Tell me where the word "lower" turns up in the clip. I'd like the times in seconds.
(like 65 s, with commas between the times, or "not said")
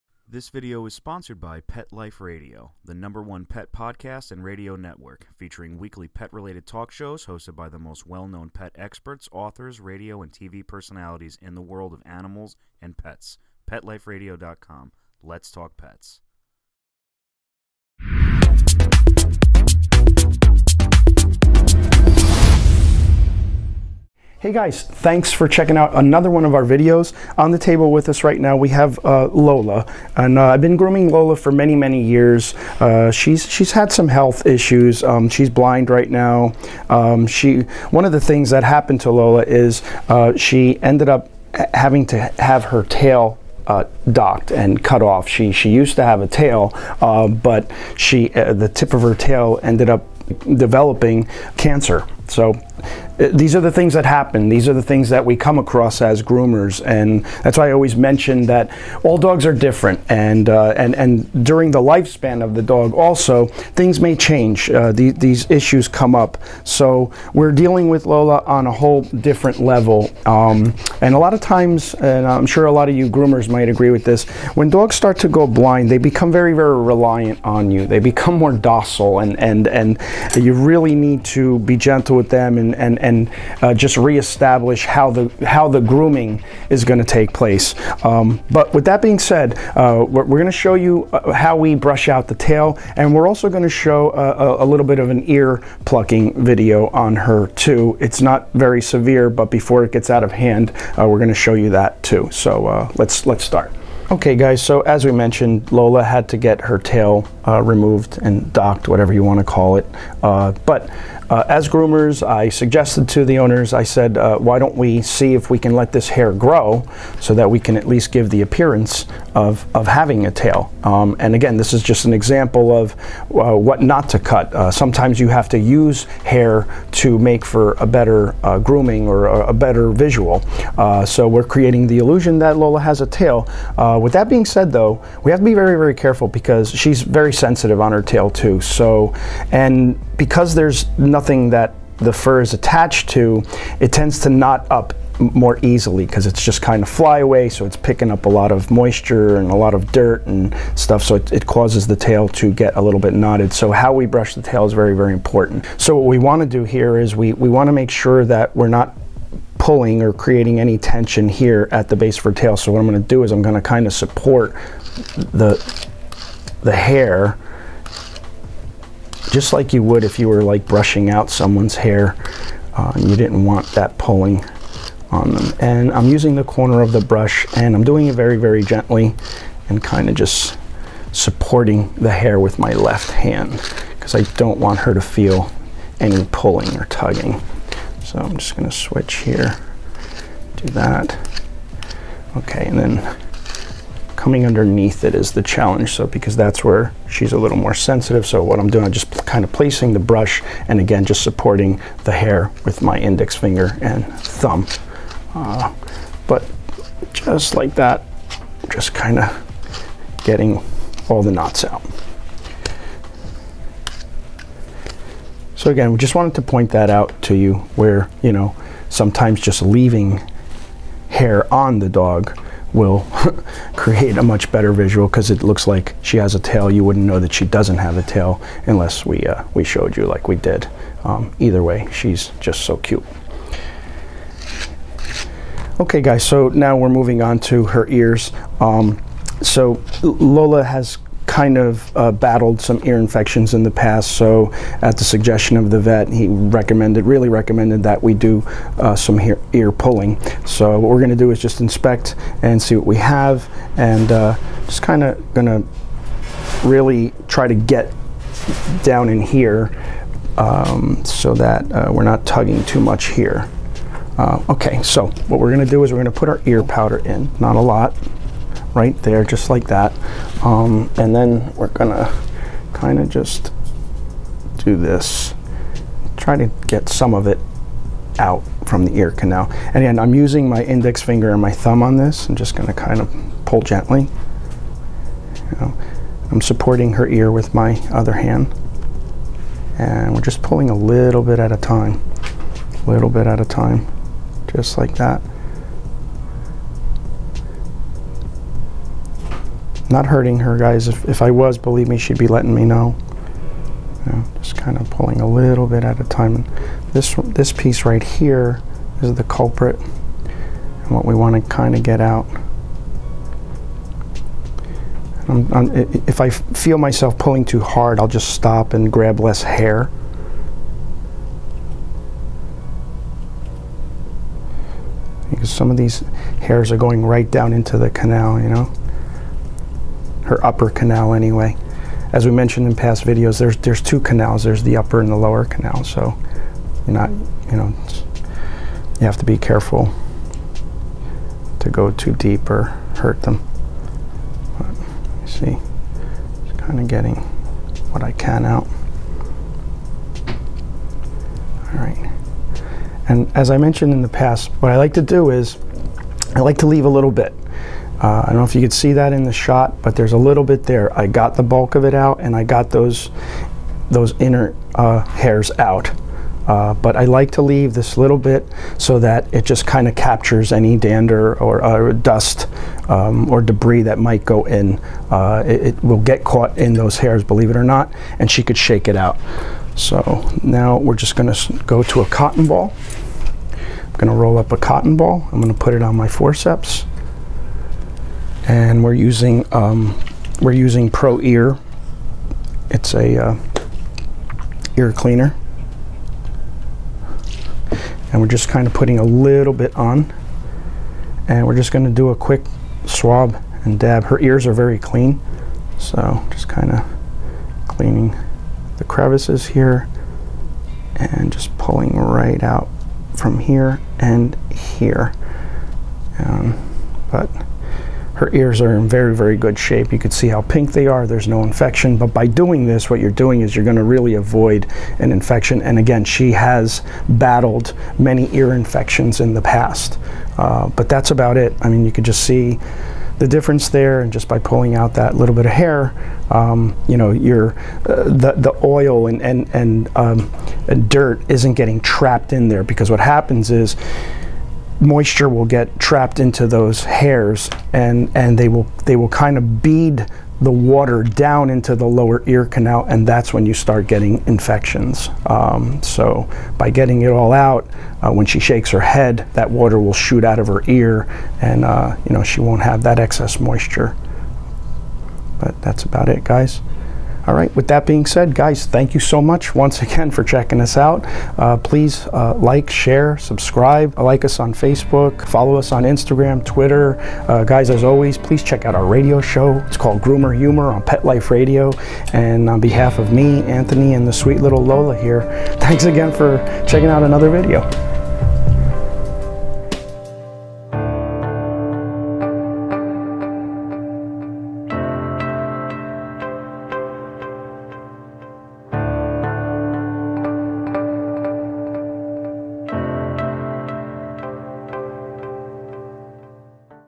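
335 s, 451 s.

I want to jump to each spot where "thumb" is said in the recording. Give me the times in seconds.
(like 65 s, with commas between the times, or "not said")
204 s, 281 s.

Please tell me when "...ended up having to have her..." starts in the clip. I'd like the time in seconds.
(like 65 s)
40 s.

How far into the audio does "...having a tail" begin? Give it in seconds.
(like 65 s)
119 s.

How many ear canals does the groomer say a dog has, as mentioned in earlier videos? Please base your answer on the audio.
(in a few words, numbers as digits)
2.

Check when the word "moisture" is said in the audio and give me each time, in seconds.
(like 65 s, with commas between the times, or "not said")
148 s, 444 s, 463 s.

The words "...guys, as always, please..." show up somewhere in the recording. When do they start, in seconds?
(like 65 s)
477 s.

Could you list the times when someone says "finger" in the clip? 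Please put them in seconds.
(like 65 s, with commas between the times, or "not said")
203 s, 281 s.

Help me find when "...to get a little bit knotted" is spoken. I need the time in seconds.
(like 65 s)
152 s.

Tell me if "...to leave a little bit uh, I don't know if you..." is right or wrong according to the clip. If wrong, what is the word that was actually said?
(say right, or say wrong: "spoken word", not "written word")
right.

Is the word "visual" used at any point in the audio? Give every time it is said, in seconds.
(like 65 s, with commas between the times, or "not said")
129 s, 224 s.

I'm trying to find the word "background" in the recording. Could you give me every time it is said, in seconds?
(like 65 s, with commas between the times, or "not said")
not said.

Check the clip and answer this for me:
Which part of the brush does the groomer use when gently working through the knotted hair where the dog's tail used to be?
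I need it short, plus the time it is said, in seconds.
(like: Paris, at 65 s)
the corner, at 176 s.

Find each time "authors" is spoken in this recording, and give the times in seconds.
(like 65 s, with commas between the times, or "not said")
9 s.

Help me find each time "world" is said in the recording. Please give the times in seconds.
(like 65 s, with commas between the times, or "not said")
11 s.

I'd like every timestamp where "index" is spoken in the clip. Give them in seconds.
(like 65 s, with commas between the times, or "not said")
202 s, 280 s.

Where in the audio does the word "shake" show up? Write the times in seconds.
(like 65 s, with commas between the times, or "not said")
378 s, 458 s.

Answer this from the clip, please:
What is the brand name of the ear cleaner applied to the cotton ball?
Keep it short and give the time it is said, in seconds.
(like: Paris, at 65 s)
Pro Ear, at 390 s.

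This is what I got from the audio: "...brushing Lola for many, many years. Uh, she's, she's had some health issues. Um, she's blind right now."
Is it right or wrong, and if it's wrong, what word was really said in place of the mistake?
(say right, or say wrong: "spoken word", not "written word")
wrong: "grooming", not "brushing".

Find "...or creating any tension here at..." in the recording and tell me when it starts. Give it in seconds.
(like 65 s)
160 s.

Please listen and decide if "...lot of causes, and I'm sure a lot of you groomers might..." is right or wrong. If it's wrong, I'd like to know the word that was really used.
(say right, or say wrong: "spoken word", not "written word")
wrong: "times", not "causes".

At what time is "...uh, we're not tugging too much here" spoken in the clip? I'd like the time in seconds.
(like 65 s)
261 s.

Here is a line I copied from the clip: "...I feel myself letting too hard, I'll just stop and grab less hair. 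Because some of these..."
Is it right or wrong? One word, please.
wrong.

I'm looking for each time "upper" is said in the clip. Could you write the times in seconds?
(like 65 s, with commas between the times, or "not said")
330 s, 334 s.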